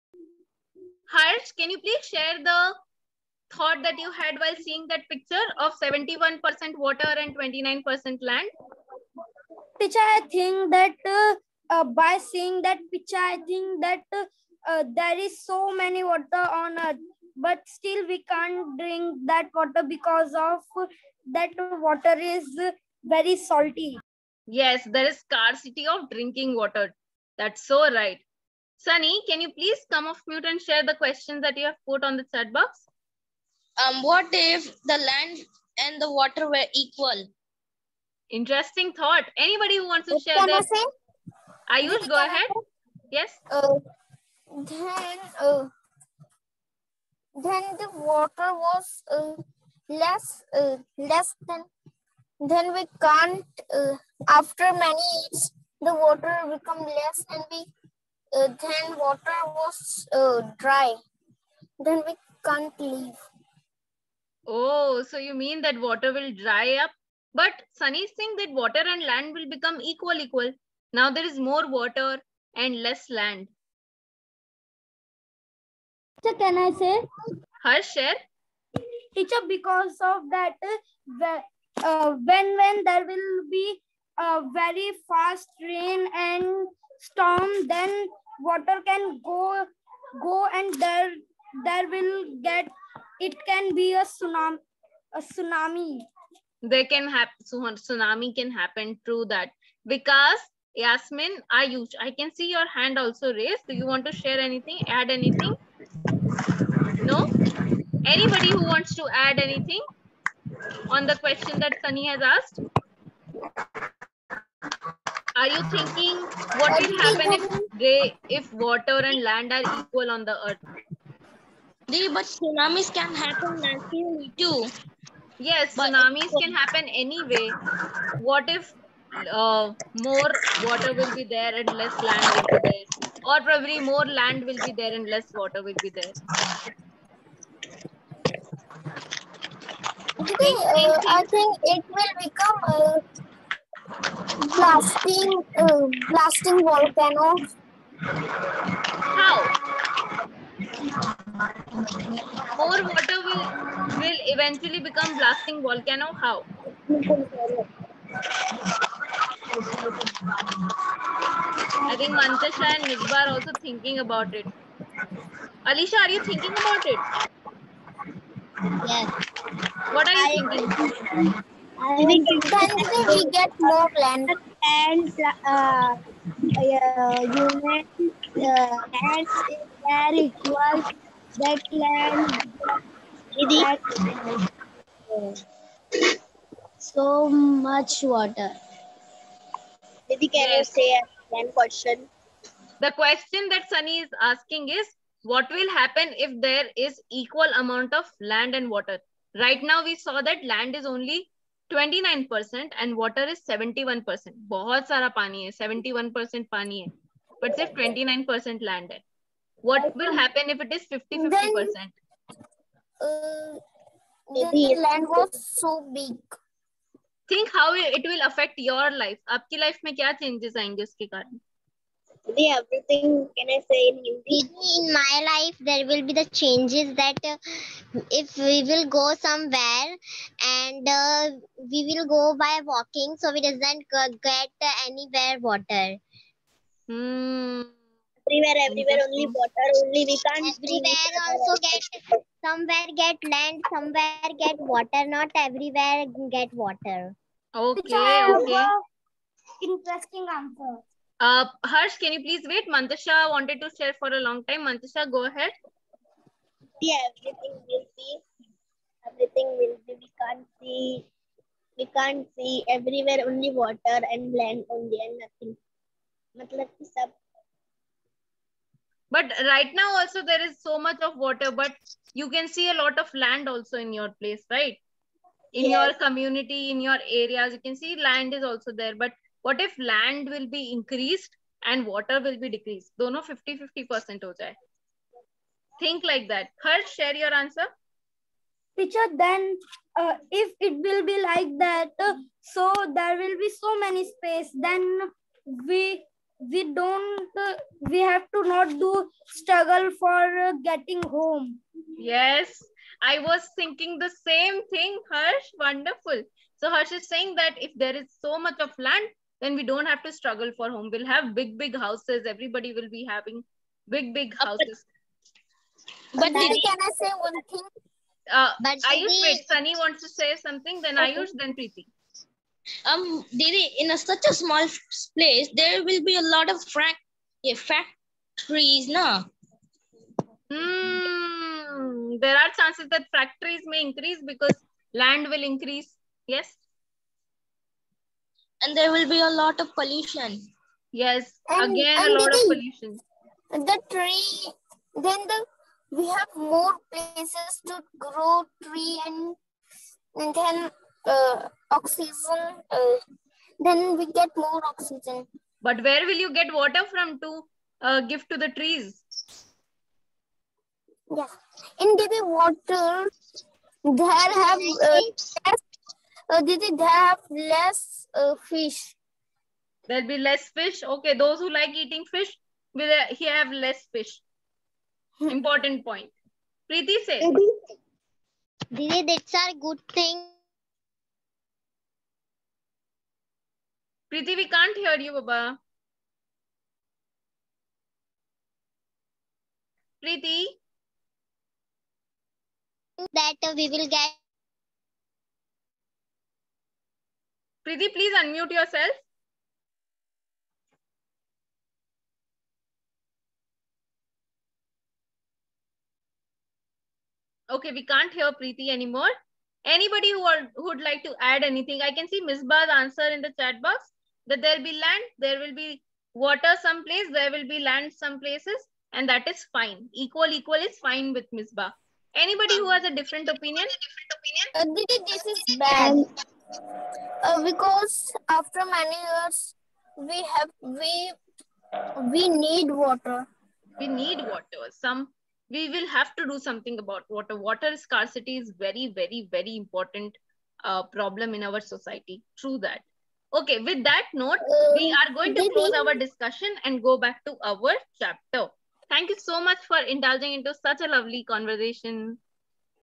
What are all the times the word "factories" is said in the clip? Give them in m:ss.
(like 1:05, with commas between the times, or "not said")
5:27, 5:33.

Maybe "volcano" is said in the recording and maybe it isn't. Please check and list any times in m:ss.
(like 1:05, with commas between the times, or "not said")
2:26, 2:35.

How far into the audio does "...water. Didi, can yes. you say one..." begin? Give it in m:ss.
3:08.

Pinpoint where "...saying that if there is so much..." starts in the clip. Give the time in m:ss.
5:07.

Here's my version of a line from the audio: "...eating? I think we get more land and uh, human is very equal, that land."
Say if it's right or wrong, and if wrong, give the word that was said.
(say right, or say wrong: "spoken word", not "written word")
wrong: "thinking", not "eating".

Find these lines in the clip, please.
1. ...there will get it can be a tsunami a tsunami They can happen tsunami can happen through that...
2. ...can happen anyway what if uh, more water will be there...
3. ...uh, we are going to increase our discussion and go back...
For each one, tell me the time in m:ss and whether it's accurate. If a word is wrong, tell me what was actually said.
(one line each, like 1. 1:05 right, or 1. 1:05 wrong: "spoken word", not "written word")
1. 1:31 right
2. 2:06 right
3. 7:24 wrong: "close", not "increase".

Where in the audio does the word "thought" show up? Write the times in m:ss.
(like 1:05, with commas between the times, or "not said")
0:03, 0:38.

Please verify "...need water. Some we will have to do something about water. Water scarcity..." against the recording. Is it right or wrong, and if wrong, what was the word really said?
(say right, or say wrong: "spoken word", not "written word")
right.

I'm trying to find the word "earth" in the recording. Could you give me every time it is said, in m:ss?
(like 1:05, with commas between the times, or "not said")
0:16, 2:00.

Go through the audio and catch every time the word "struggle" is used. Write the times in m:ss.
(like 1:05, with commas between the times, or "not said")
4:59, 5:10.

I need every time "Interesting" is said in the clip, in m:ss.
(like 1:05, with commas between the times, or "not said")
0:38, 4:09.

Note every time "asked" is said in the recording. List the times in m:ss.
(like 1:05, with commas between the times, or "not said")
1:52.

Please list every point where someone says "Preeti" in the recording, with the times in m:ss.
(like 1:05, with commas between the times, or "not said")
5:21, 6:16, 6:24, 6:30, 6:37, 6:48.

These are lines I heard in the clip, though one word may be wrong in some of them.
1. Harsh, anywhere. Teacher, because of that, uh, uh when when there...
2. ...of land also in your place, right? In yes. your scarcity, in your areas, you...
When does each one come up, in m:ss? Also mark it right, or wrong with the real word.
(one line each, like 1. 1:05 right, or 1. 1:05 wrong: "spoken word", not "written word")
1. 1:17 wrong: "share", not "anywhere"
2. 4:32 wrong: "community", not "scarcity".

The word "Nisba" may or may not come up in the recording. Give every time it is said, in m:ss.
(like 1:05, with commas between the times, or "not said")
2:42, 6:52, 7:01.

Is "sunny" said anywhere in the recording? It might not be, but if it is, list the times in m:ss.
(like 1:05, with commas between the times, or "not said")
0:28, 1:07, 1:51, 3:13, 5:19.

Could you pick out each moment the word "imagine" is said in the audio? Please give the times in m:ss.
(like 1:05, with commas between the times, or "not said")
not said.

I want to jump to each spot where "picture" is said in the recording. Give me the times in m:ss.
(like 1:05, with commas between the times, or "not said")
0:05, 0:12.